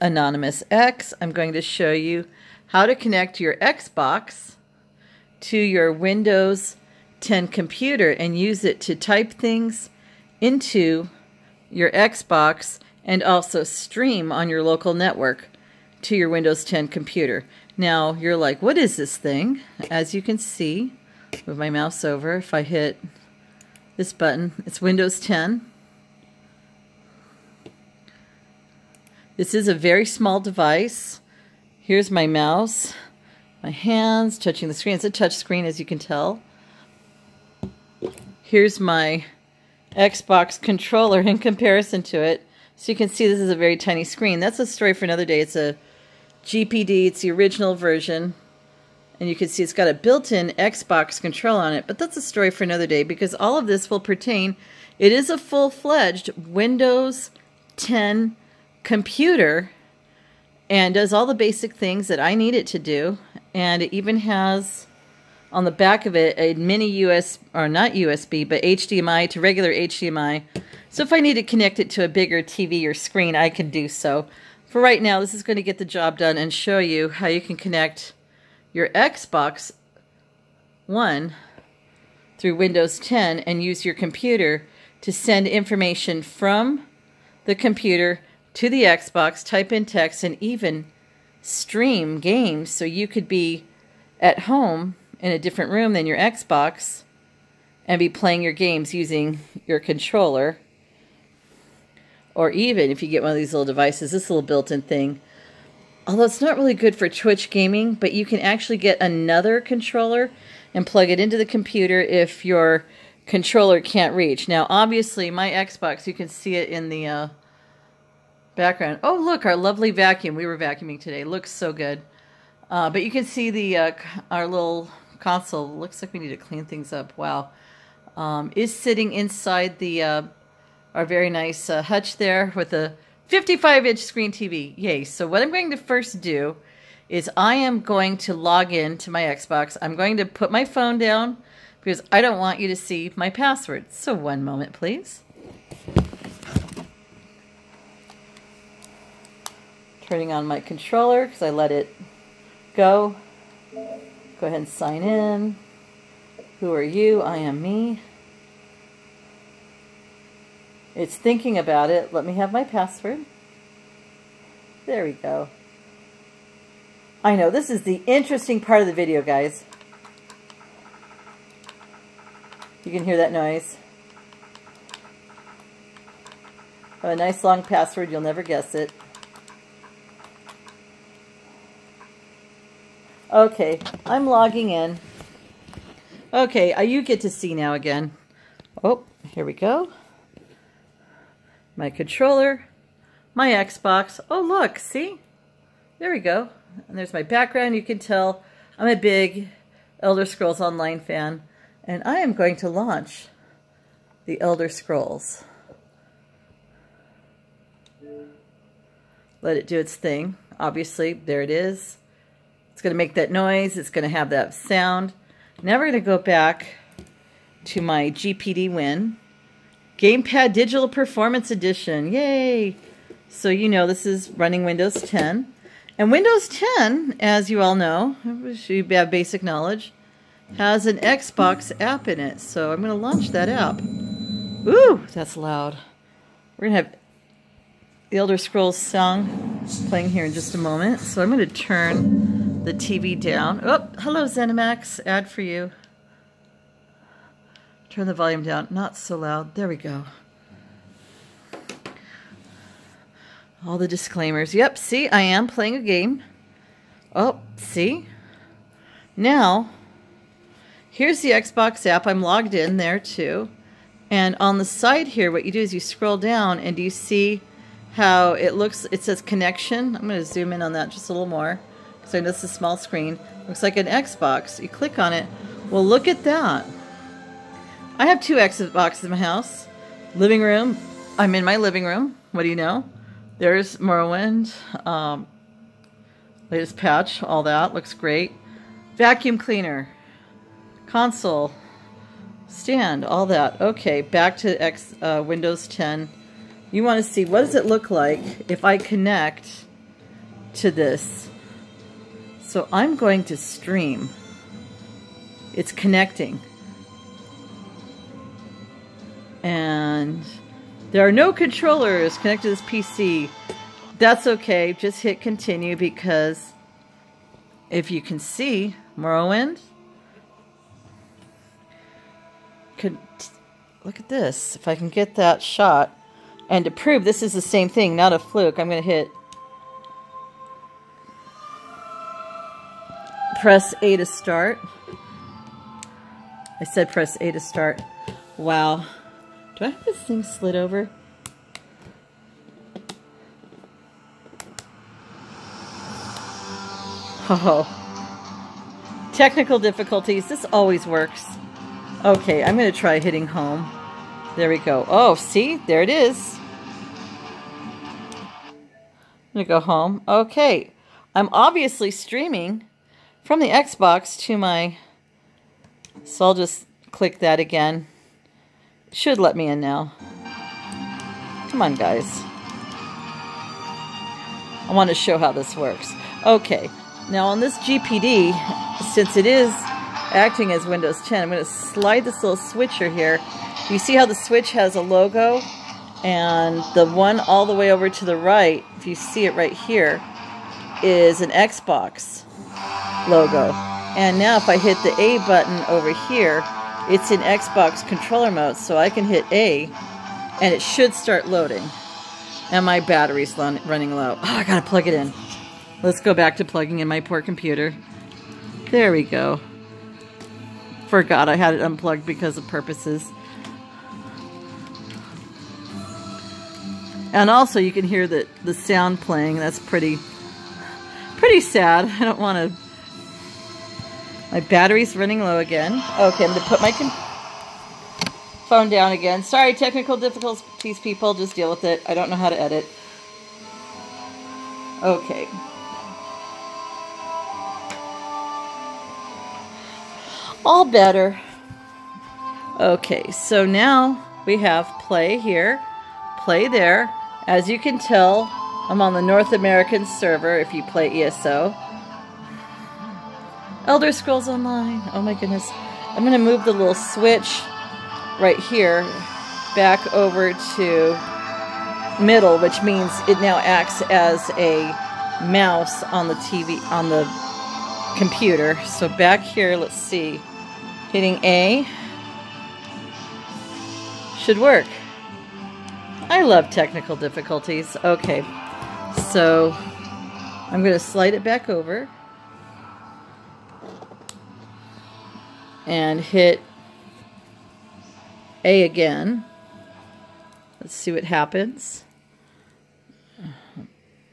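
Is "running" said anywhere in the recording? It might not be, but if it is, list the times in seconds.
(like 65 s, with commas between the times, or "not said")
224 s, 403 s, 424 s.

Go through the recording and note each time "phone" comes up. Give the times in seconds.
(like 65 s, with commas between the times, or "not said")
140 s, 428 s.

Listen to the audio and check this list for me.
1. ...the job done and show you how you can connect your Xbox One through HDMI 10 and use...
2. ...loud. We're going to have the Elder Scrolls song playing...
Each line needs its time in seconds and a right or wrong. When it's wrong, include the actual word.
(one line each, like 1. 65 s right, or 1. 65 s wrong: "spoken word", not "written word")
1. 75 s wrong: "Windows", not "HDMI"
2. 235 s right.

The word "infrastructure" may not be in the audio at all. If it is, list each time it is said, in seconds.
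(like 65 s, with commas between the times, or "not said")
not said.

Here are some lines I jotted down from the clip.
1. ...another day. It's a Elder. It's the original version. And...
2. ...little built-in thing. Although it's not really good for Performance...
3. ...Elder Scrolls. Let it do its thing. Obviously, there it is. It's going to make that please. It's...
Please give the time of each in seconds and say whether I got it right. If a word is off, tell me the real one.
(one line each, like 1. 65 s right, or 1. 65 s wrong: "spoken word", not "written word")
1. 45 s wrong: "GPD", not "Elder"
2. 104 s wrong: "Twitch", not "Performance"
3. 204 s wrong: "noise", not "please".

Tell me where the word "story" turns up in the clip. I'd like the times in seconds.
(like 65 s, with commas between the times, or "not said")
44 s, 52 s.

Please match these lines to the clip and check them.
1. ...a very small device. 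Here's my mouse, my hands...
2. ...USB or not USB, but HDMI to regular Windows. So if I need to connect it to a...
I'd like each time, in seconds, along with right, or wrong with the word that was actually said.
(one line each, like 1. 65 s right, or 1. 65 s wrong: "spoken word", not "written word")
1. 29 s right
2. 67 s wrong: "HDMI", not "Windows".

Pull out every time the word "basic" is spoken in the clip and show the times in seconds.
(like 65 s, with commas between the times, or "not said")
61 s, 229 s.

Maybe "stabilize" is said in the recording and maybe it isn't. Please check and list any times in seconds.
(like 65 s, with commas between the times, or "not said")
not said.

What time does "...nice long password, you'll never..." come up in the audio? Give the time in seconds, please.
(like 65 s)
177 s.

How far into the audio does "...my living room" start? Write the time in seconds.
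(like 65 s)
281 s.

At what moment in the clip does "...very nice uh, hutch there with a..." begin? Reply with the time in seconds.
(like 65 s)
131 s.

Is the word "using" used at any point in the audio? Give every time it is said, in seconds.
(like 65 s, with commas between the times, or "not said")
98 s.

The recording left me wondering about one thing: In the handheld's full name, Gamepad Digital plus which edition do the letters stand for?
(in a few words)
Performance Edition.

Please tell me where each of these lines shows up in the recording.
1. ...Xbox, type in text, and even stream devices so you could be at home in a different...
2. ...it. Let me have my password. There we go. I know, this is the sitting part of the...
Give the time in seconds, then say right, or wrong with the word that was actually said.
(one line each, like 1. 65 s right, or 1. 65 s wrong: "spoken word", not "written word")
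1. 88 s wrong: "games", not "devices"
2. 161 s wrong: "interesting", not "sitting".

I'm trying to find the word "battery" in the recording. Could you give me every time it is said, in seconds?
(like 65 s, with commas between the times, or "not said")
402 s, 424 s.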